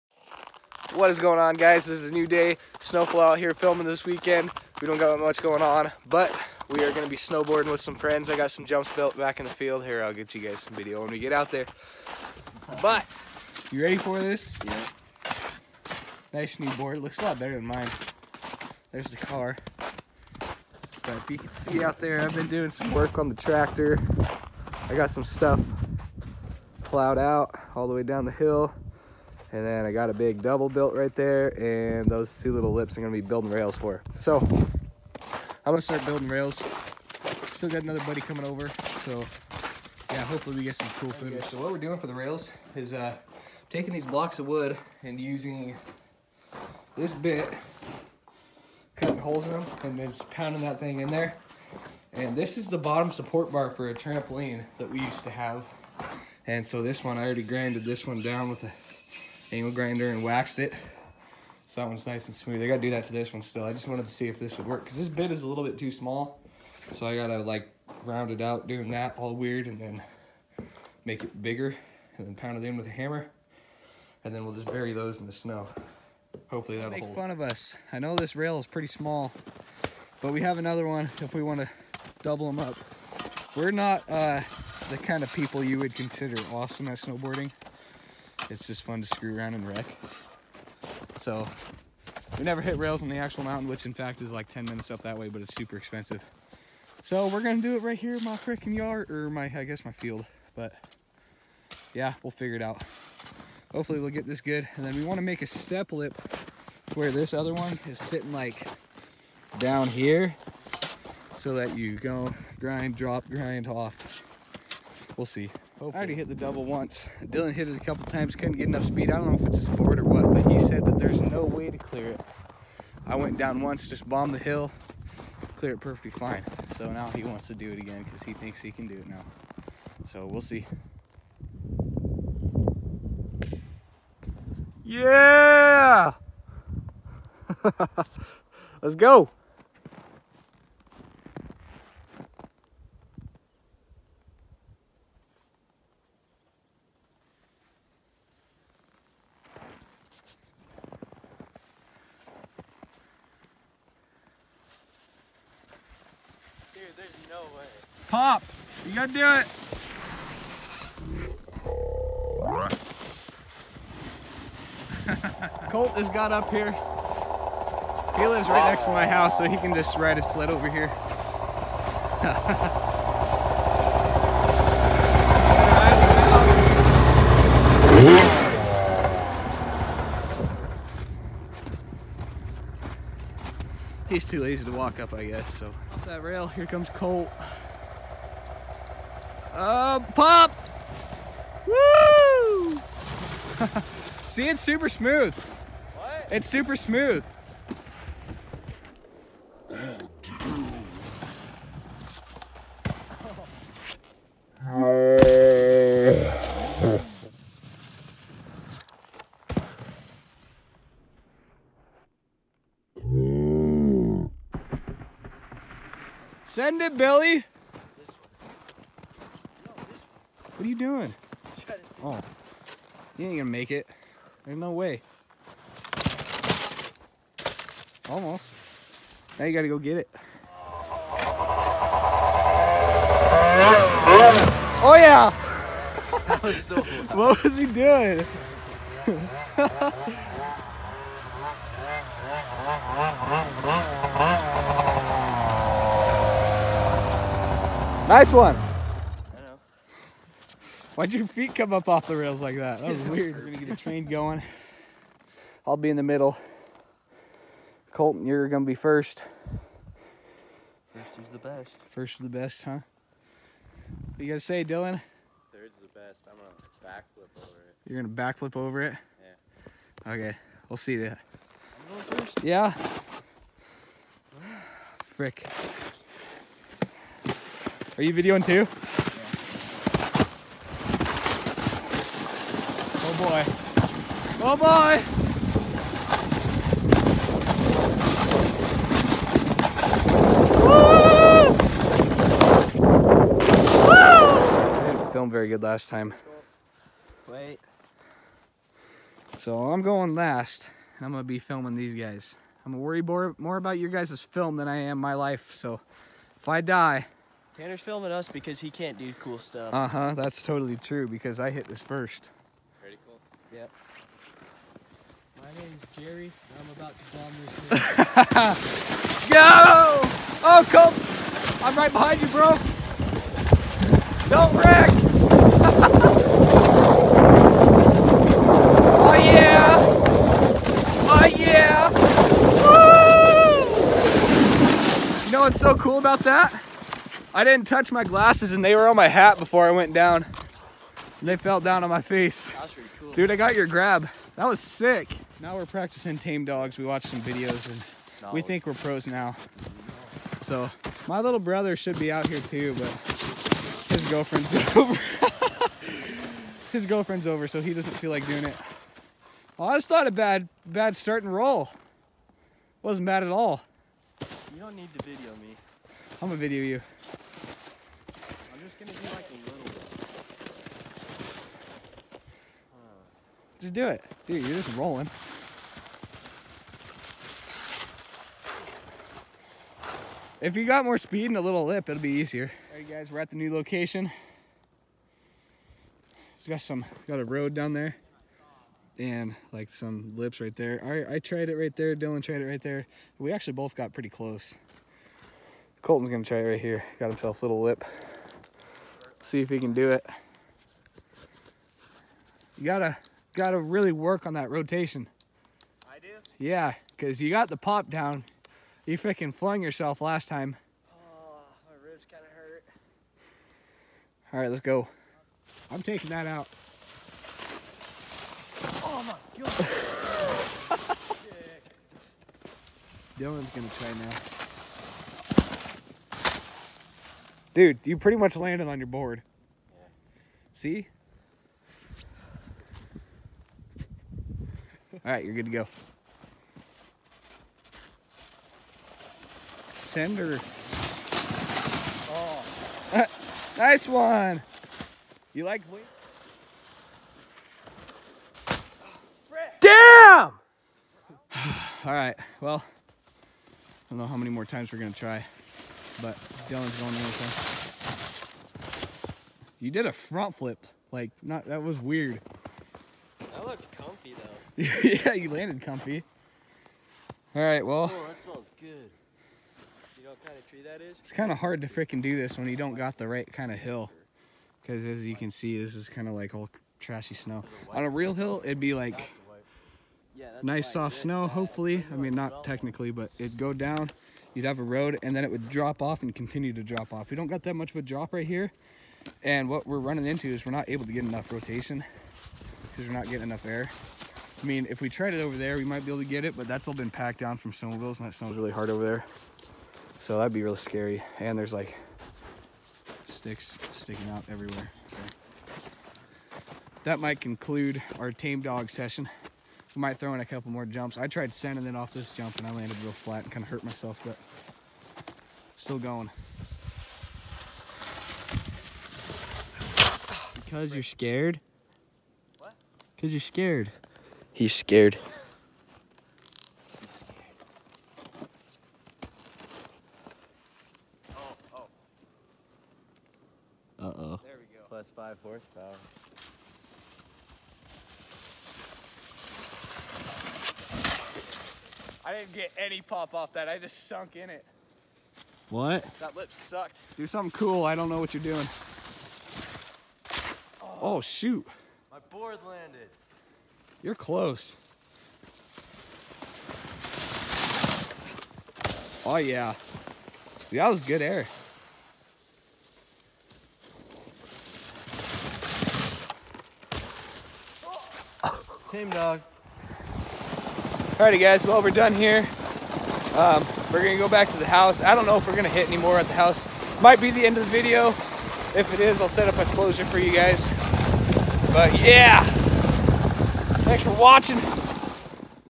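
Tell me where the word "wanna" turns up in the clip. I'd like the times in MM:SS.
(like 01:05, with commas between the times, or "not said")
01:21, 01:45.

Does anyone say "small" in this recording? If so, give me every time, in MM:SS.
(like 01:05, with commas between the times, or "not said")
01:05, 01:18.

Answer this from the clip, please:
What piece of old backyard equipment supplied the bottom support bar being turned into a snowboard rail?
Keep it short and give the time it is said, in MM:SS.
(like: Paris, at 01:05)
Trampoline, at 00:53.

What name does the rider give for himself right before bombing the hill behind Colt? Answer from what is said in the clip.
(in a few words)
Jerry.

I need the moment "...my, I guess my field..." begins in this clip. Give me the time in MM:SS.
01:39.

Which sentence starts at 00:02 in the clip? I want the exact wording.
SNO-FLO out here filming this weekend.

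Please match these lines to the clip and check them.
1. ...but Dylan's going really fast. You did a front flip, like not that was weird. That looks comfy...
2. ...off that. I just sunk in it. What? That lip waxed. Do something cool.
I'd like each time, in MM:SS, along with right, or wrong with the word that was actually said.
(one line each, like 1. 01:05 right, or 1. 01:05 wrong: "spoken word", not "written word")
1. 07:36 right
2. 09:03 wrong: "sucked", not "waxed".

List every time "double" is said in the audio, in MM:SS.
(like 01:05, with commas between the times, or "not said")
00:30, 01:22, 01:56.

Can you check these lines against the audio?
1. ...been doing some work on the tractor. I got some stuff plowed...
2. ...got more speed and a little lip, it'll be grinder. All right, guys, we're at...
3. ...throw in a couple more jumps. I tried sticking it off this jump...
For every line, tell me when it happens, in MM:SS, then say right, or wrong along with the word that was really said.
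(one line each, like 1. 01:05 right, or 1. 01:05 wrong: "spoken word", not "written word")
1. 00:22 right
2. 06:20 wrong: "easier", not "grinder"
3. 08:29 wrong: "sending", not "sticking".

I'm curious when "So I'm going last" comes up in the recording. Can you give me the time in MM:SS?
04:59.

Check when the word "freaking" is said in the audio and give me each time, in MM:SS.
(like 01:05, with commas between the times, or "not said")
01:38, 06:48, 07:51.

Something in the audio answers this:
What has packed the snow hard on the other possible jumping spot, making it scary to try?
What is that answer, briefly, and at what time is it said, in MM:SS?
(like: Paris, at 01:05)
Snowmobiles, at 08:17.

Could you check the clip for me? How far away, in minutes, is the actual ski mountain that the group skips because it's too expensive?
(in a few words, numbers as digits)
10 minutes.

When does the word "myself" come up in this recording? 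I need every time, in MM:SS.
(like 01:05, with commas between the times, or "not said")
08:33.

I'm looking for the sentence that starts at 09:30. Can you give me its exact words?
Alrighty guys, well we're done here.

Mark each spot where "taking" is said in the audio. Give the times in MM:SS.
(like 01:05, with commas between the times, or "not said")
00:43, 06:55.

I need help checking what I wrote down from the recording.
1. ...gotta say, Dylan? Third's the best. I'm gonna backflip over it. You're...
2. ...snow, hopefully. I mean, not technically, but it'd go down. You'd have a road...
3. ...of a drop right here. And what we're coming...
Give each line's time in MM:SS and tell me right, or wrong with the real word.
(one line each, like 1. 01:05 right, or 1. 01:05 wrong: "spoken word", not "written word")
1. 04:24 right
2. 08:00 right
3. 08:07 wrong: "running", not "coming".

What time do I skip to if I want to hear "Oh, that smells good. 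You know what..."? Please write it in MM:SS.
07:47.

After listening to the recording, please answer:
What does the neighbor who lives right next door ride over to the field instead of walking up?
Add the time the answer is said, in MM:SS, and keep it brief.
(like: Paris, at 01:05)
A sled, at 02:50.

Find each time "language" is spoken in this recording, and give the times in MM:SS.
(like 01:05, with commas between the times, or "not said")
not said.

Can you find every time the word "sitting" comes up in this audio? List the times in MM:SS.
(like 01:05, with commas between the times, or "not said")
01:47.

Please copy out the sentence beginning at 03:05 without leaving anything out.
Off that rail, here comes Colt.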